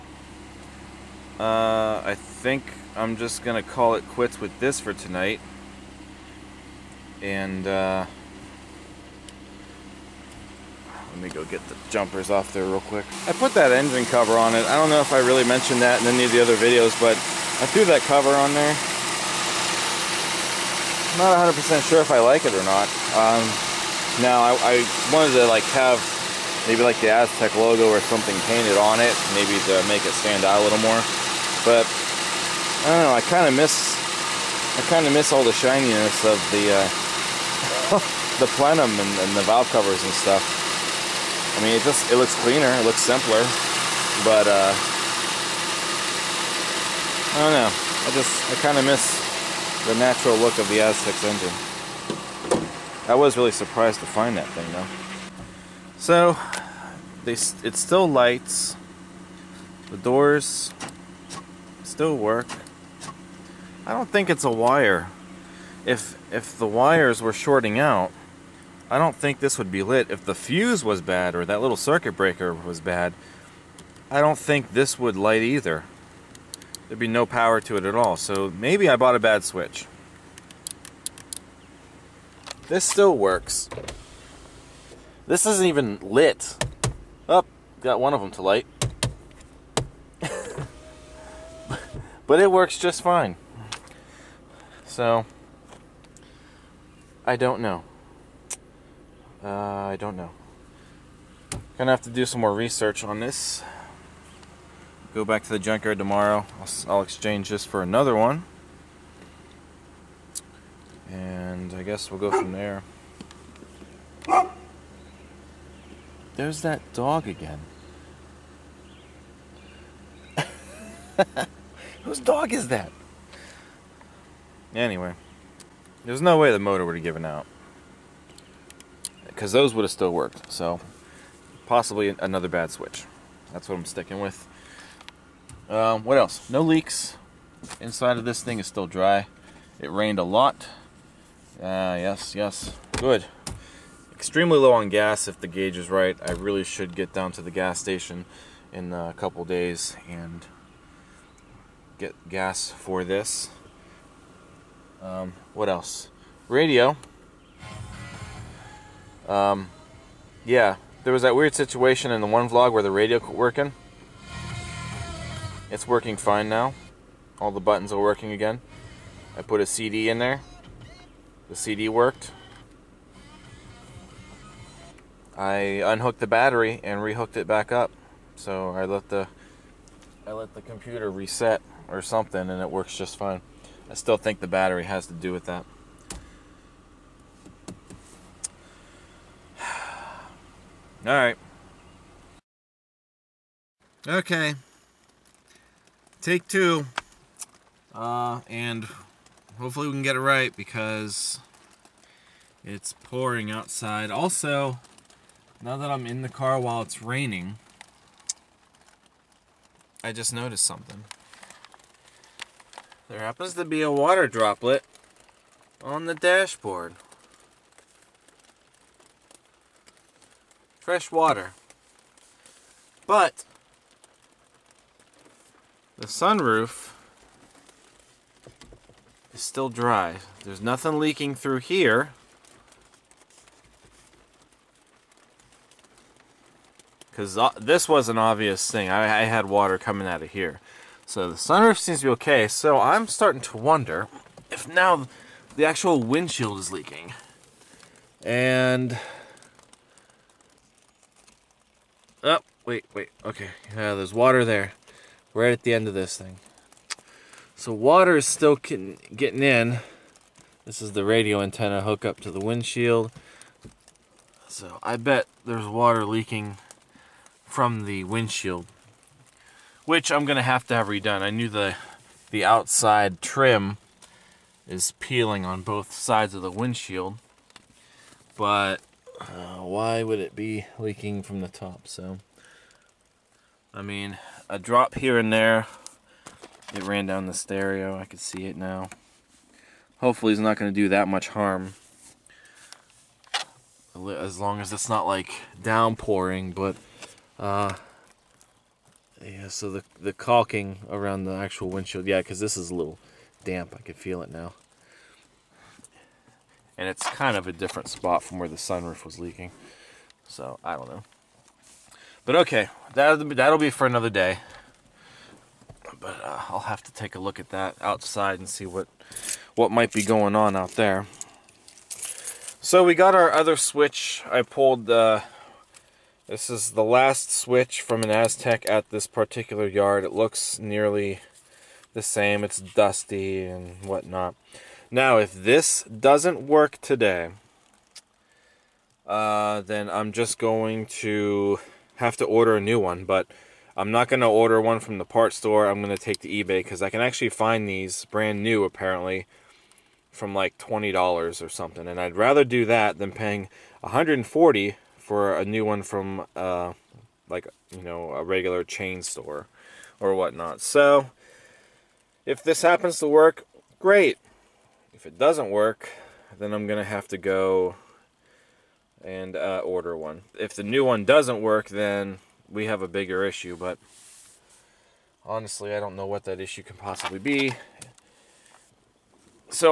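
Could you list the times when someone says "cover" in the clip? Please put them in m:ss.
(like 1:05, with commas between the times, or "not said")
0:14, 0:18, 0:39.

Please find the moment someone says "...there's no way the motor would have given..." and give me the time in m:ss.
2:06.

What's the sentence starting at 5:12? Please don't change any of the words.
But okay, that'll be, that'll be for another day.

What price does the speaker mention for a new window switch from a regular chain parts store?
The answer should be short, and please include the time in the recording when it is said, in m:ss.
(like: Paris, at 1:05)
140, at 5:53.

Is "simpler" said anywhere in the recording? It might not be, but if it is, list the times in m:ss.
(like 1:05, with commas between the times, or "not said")
0:43.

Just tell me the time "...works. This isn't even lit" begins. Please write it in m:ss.
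1:23.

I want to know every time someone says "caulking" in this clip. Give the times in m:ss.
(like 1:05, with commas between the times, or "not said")
5:00.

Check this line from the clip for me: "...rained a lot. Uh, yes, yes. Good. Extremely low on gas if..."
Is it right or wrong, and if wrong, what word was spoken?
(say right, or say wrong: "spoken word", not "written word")
right.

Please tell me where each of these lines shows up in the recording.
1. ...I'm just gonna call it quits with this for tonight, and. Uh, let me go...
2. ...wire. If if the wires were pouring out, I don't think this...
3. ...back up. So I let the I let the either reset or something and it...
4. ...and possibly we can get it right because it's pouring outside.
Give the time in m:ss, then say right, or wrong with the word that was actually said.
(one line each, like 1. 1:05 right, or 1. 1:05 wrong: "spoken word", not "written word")
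1. 0:02 right
2. 1:04 wrong: "shorting", not "pouring"
3. 2:57 wrong: "computer", not "either"
4. 3:18 wrong: "hopefully", not "possibly".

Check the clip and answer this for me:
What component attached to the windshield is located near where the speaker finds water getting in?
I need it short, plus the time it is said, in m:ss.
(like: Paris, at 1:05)
radio antenna hookup, at 4:21.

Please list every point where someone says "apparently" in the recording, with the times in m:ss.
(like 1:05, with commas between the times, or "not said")
5:48.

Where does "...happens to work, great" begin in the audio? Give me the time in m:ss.
6:02.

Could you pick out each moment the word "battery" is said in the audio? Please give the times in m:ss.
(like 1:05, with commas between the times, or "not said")
2:56, 3:04.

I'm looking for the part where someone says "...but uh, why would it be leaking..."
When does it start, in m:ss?
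4:38.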